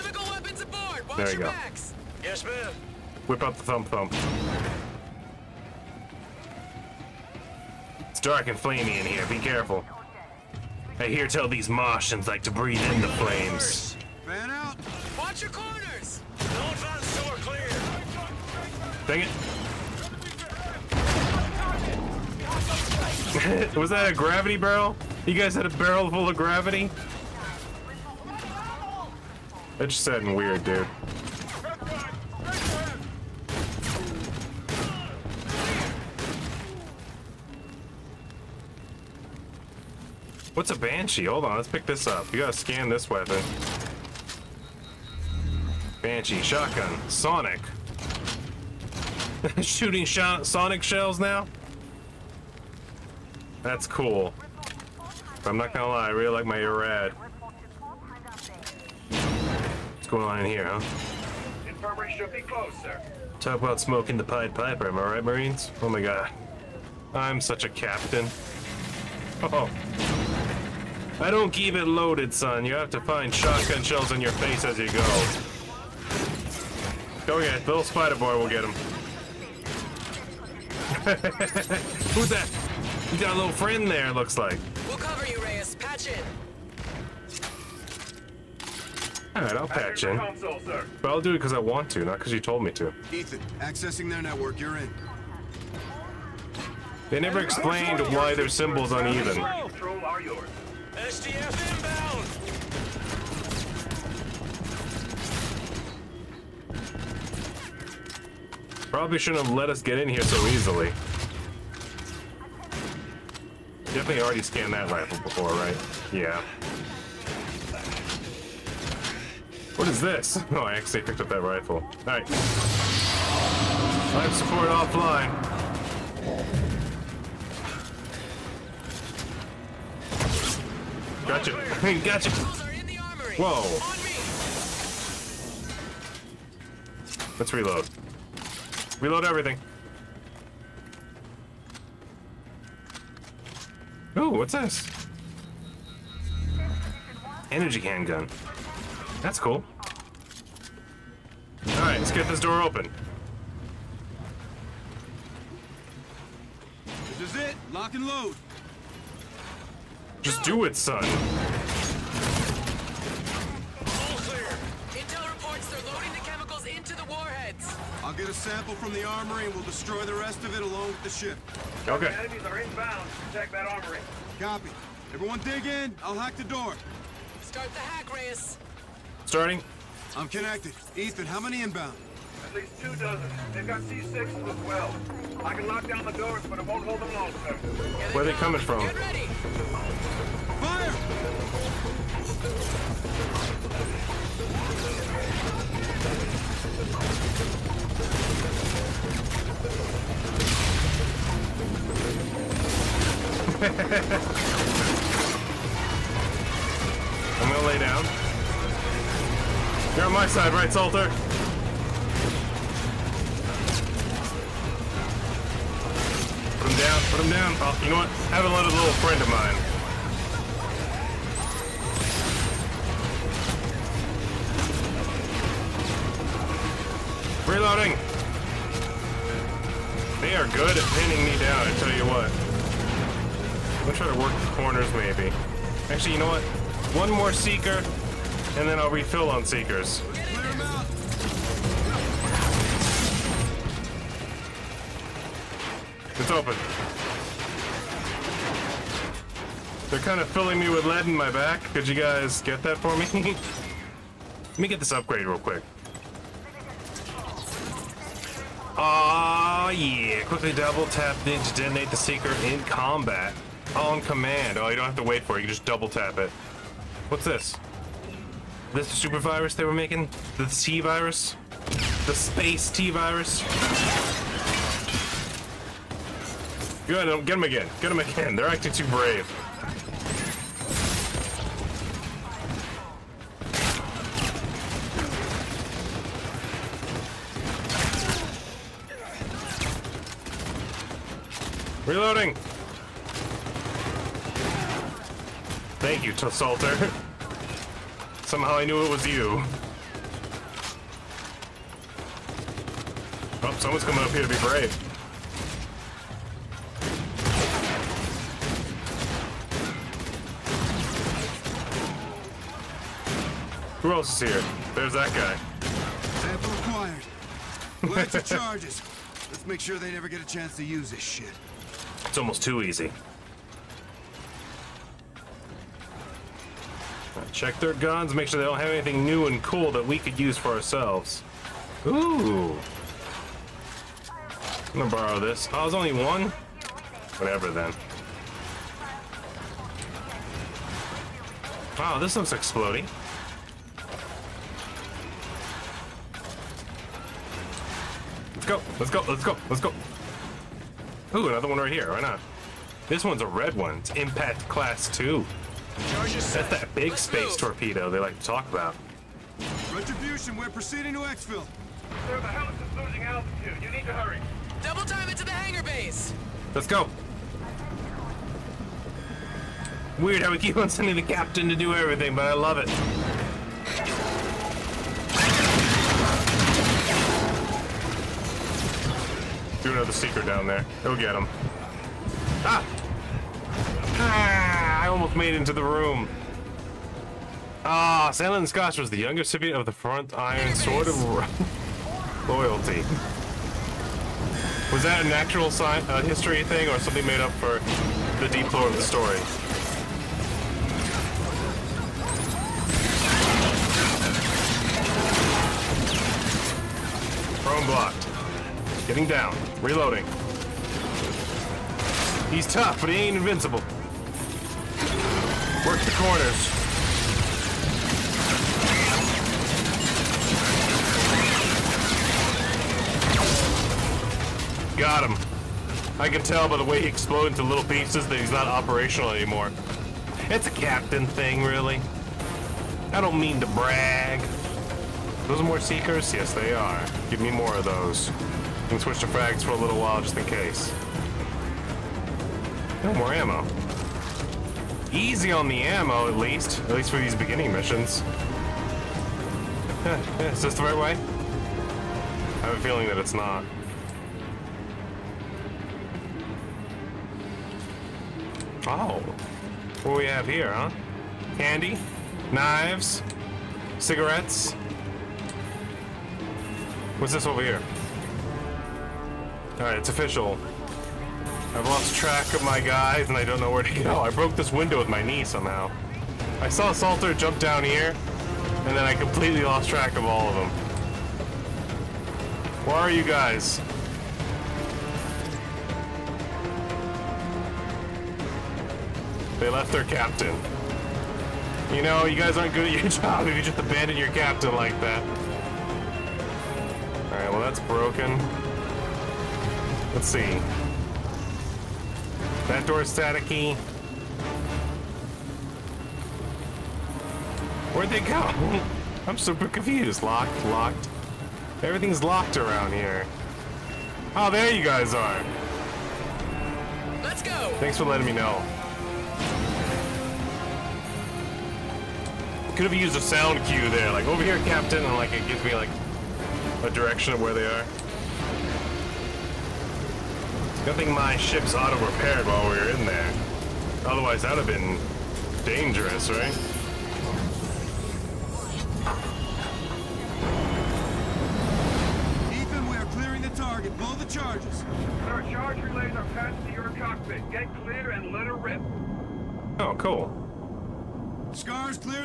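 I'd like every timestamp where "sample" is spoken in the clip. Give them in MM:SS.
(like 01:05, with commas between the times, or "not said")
02:48, 05:16.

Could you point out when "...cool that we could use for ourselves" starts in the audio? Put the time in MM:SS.
05:29.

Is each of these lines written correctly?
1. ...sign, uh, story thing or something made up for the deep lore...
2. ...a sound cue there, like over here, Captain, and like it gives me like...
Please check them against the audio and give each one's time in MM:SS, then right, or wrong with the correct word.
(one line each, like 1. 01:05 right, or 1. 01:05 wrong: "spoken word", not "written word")
1. 06:35 wrong: "history", not "story"
2. 08:42 right.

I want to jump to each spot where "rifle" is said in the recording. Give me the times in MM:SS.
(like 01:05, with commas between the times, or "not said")
01:54, 02:01.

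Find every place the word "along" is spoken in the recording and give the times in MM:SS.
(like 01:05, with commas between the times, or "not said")
02:50.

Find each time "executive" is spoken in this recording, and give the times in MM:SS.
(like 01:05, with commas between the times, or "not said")
not said.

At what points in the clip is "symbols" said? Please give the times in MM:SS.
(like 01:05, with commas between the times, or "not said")
01:38.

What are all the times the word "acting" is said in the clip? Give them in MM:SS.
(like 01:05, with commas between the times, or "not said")
04:38.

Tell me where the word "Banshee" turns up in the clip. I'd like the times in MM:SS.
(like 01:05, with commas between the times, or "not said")
00:40, 00:46.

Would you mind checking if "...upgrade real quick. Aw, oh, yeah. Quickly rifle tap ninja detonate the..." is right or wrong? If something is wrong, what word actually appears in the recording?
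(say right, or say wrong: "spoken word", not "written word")
wrong: "double", not "rifle".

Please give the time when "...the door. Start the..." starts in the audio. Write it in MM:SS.
02:56.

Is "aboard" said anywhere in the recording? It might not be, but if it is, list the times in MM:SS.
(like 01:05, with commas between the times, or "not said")
00:00.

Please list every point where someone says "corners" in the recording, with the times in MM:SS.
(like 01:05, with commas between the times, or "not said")
00:15, 03:54, 06:55.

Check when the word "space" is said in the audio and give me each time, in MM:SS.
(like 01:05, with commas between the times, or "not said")
04:32, 05:57.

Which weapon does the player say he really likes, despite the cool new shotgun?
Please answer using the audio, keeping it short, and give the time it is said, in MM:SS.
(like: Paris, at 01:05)
Erad, at 00:56.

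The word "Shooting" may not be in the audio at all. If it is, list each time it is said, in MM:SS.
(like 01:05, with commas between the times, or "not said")
00:49.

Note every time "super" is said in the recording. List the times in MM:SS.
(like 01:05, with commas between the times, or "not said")
04:28, 08:29.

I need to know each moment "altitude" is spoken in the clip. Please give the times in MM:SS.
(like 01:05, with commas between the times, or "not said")
06:03.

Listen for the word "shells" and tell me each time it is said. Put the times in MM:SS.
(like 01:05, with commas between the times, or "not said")
00:50, 01:13.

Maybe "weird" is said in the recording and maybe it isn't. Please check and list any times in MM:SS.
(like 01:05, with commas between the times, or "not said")
00:30, 06:09.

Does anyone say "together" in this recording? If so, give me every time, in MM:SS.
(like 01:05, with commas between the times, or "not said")
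not said.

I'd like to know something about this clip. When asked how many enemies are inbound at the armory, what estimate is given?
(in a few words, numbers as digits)
at least two dozen.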